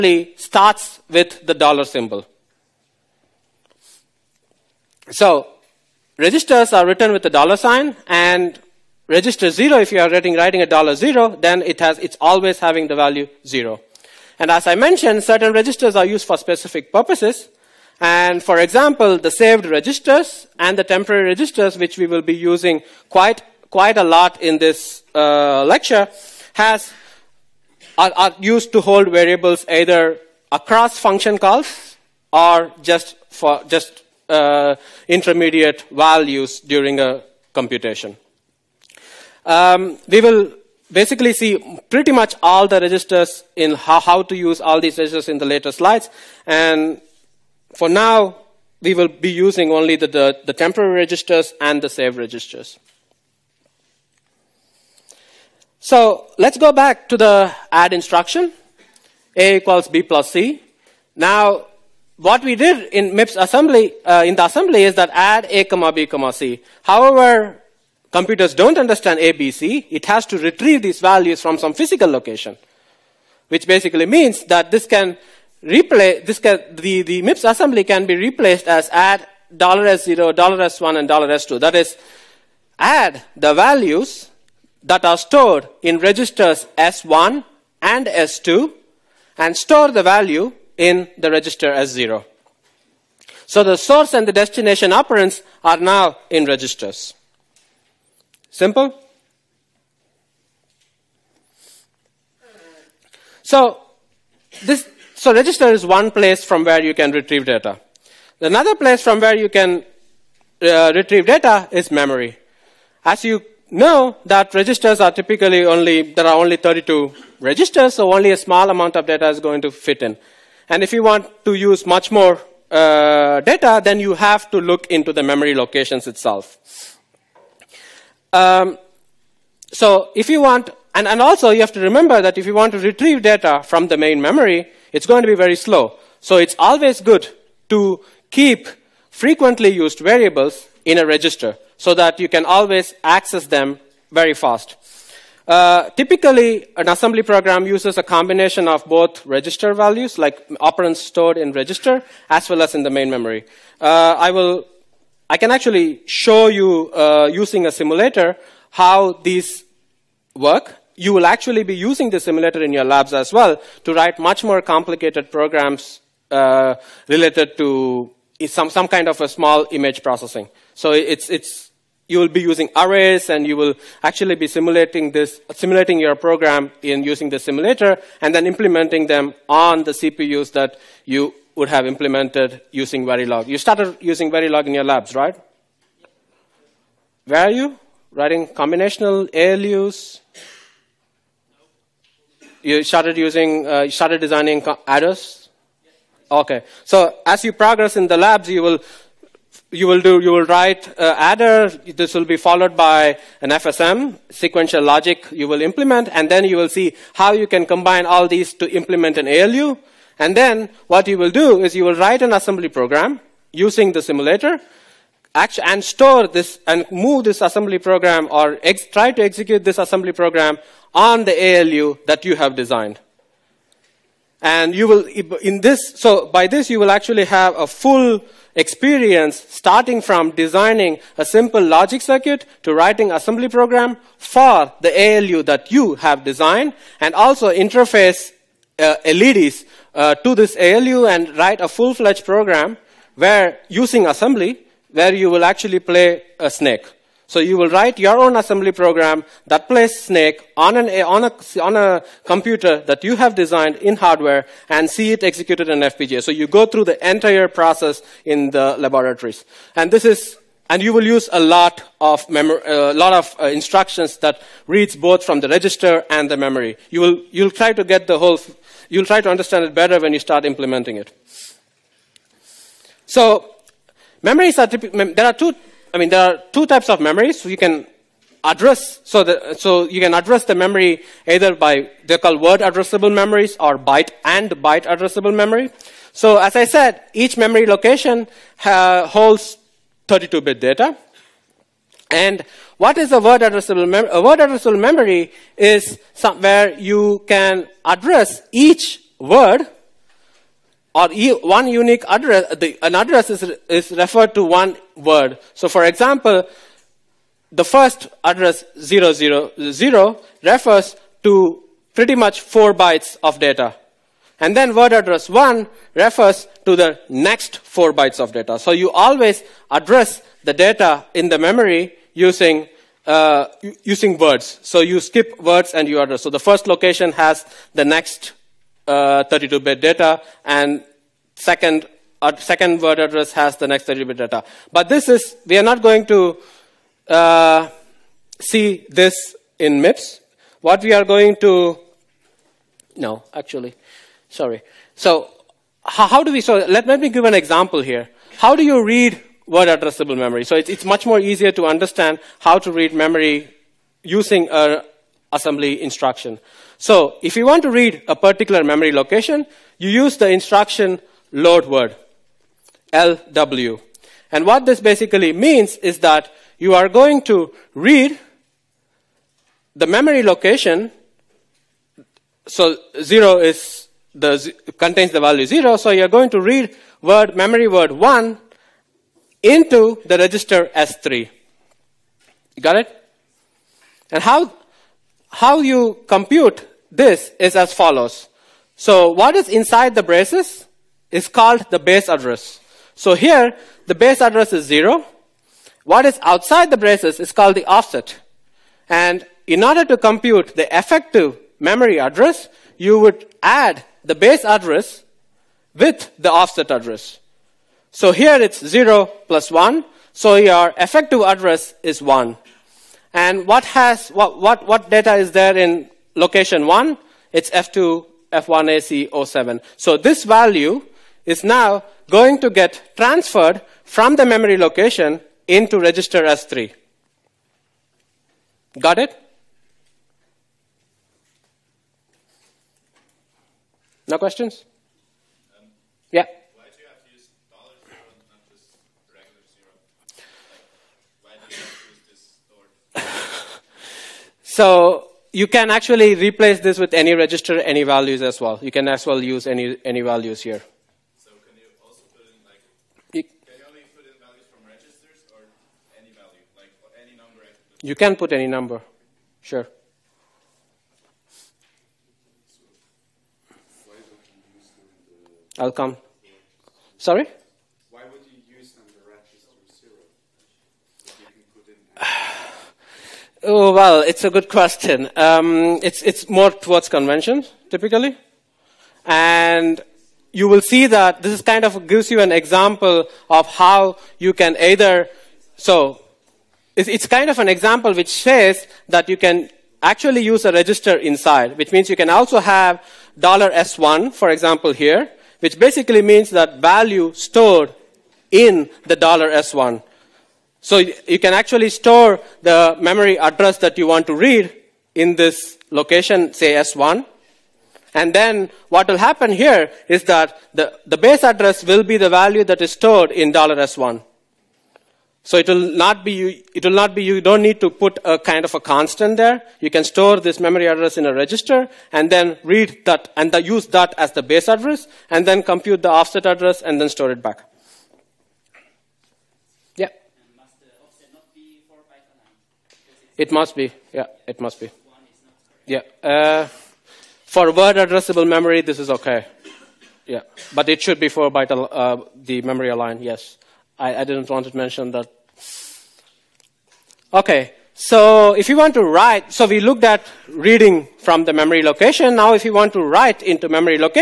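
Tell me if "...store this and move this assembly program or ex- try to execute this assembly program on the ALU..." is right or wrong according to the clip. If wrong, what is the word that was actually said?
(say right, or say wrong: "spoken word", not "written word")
right.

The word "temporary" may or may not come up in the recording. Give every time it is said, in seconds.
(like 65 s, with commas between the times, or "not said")
20 s, 50 s.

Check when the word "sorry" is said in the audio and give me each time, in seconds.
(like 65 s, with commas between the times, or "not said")
344 s, 466 s.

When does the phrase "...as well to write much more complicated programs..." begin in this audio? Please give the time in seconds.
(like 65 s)
163 s.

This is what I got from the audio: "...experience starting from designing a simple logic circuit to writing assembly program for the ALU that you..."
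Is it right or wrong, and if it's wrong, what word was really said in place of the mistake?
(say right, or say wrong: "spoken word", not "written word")
right.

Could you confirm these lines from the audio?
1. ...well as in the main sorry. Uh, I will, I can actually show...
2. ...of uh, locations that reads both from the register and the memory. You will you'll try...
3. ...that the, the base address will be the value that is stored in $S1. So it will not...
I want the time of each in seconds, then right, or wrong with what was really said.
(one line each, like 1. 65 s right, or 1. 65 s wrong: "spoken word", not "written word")
1. 152 s wrong: "memory", not "sorry"
2. 263 s wrong: "instructions", not "locations"
3. 510 s right.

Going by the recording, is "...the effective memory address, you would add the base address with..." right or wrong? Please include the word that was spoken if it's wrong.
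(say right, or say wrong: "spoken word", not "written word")
right.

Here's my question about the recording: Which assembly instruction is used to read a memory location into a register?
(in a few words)
load word (LW).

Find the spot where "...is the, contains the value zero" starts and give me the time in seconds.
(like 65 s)
373 s.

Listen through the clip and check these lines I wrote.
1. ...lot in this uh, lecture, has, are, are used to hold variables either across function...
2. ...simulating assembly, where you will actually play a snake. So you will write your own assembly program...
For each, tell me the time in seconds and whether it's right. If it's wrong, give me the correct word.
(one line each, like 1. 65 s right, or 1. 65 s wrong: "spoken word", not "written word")
1. 24 s right
2. 243 s wrong: "using", not "simulating".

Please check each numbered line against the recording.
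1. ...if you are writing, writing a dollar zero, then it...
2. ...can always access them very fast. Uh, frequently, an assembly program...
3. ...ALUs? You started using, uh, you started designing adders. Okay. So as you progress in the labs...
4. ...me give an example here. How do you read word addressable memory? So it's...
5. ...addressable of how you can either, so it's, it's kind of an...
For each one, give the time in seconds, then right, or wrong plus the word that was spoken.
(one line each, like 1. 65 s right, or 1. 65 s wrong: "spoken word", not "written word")
1. 9 s right
2. 142 s wrong: "typically", not "frequently"
3. 189 s right
4. 347 s right
5. 482 s wrong: "example", not "addressable".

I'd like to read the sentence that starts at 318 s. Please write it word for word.
So you always address the data in the memory using, uh, using words.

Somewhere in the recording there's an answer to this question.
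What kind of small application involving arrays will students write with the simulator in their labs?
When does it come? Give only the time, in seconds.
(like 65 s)
169 s.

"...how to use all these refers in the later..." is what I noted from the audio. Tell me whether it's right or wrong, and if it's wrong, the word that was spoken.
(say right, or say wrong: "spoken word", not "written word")
wrong: "registers", not "refers".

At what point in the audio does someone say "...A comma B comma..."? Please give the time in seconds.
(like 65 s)
65 s.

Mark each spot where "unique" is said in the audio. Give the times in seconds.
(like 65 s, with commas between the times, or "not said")
301 s.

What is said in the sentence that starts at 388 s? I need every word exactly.
So what is inside the braces is called the base address.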